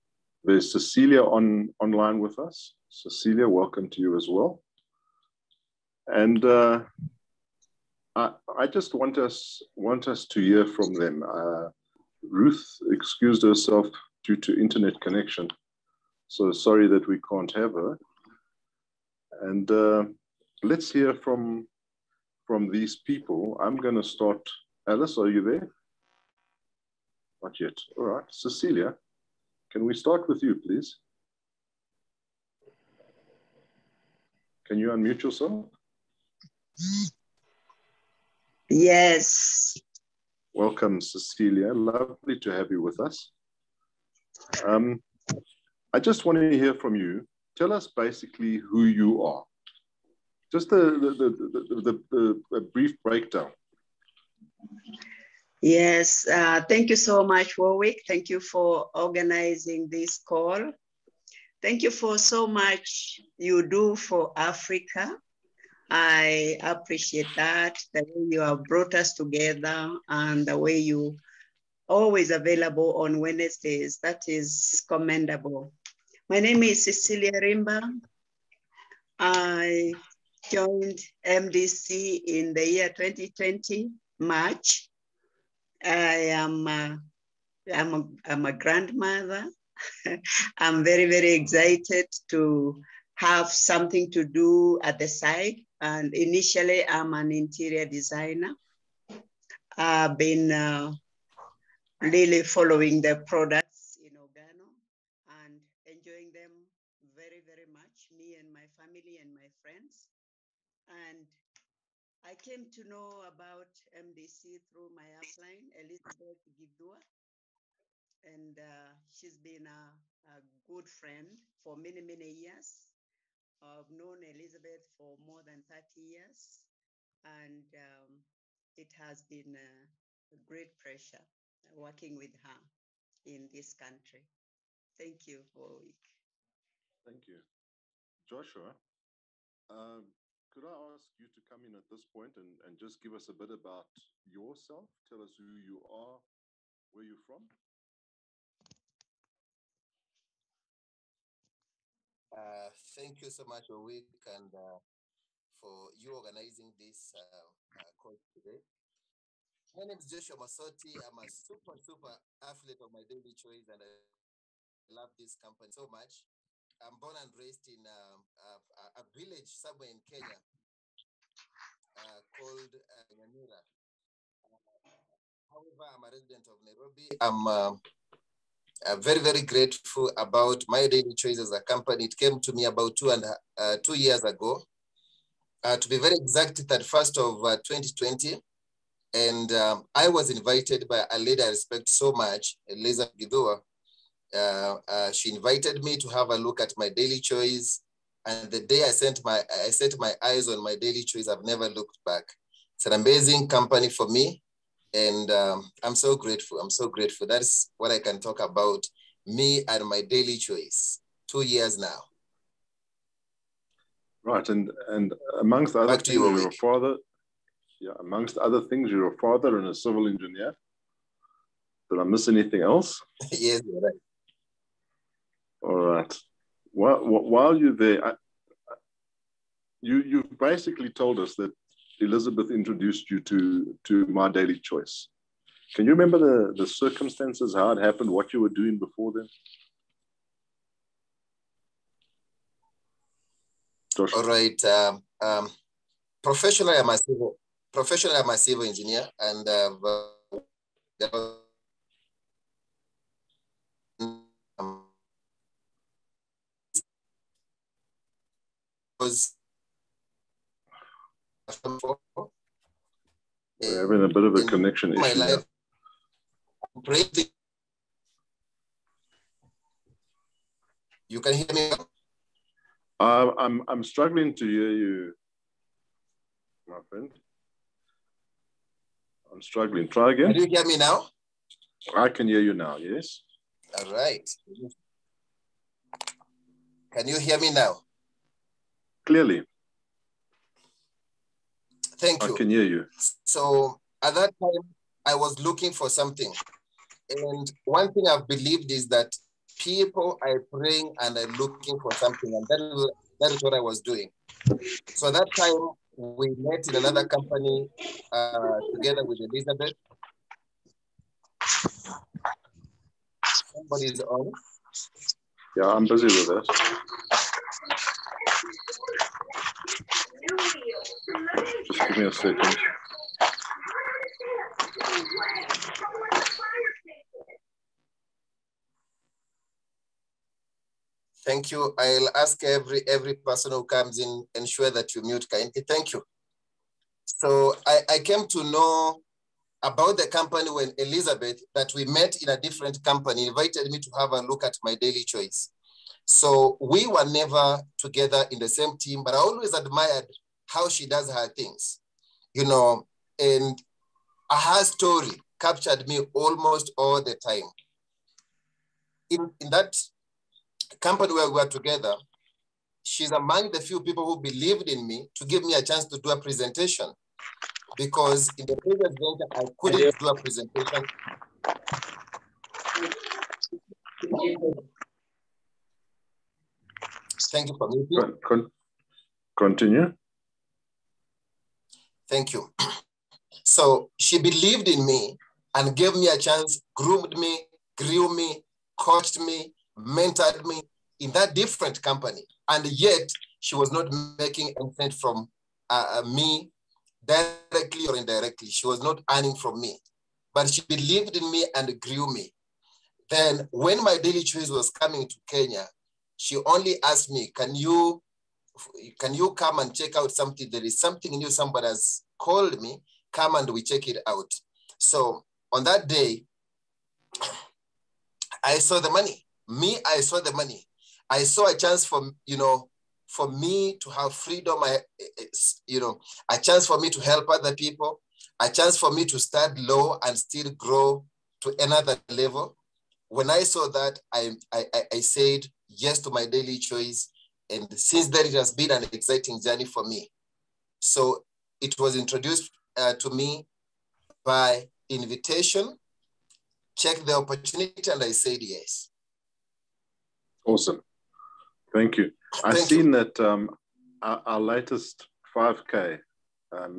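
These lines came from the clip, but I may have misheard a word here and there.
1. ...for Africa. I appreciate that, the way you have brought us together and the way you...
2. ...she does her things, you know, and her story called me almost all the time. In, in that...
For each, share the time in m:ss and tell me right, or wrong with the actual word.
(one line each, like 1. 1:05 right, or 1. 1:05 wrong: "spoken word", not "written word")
1. 1:03 right
2. 5:50 wrong: "captured", not "called".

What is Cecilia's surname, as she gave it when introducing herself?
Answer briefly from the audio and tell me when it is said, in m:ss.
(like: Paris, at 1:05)
Rimba, at 1:17.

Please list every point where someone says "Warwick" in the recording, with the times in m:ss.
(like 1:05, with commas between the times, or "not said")
0:57, 2:15.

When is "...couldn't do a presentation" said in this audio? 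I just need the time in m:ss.
6:09.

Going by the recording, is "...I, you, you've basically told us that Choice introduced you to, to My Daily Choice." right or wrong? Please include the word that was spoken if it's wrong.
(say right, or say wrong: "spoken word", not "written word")
wrong: "Elizabeth", not "Choice".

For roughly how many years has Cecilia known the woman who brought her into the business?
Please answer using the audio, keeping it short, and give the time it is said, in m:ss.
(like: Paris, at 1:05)
More than 30 years, at 2:05.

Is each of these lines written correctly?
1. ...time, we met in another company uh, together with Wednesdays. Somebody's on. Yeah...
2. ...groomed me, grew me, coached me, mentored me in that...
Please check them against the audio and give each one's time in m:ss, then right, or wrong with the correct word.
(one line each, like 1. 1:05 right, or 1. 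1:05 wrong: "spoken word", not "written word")
1. 5:05 wrong: "Elizabeth", not "Wednesdays"
2. 6:26 right.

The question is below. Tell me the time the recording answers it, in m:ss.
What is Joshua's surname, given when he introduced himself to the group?
2:40.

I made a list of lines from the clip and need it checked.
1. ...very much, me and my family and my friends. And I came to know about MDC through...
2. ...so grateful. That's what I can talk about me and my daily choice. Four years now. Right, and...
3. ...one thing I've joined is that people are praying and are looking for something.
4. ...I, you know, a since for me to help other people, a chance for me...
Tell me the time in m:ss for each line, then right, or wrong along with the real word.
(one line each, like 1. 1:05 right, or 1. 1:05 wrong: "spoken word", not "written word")
1. 1:47 right
2. 3:26 wrong: "Two", not "Four"
3. 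4:57 wrong: "believed", not "joined"
4. 7:04 wrong: "chance", not "since".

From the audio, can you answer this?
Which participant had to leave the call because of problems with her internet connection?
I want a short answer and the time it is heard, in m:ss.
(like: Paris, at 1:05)
Ruth, at 0:12.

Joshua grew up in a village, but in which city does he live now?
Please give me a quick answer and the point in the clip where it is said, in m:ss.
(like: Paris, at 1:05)
Nairobi, at 2:56.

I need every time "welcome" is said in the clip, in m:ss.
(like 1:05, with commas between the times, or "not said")
0:03, 0:40.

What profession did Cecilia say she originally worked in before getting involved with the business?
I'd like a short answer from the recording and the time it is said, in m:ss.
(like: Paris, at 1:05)
Interior designer, at 1:37.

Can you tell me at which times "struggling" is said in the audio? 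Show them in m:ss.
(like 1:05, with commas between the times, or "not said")
4:33, 4:39.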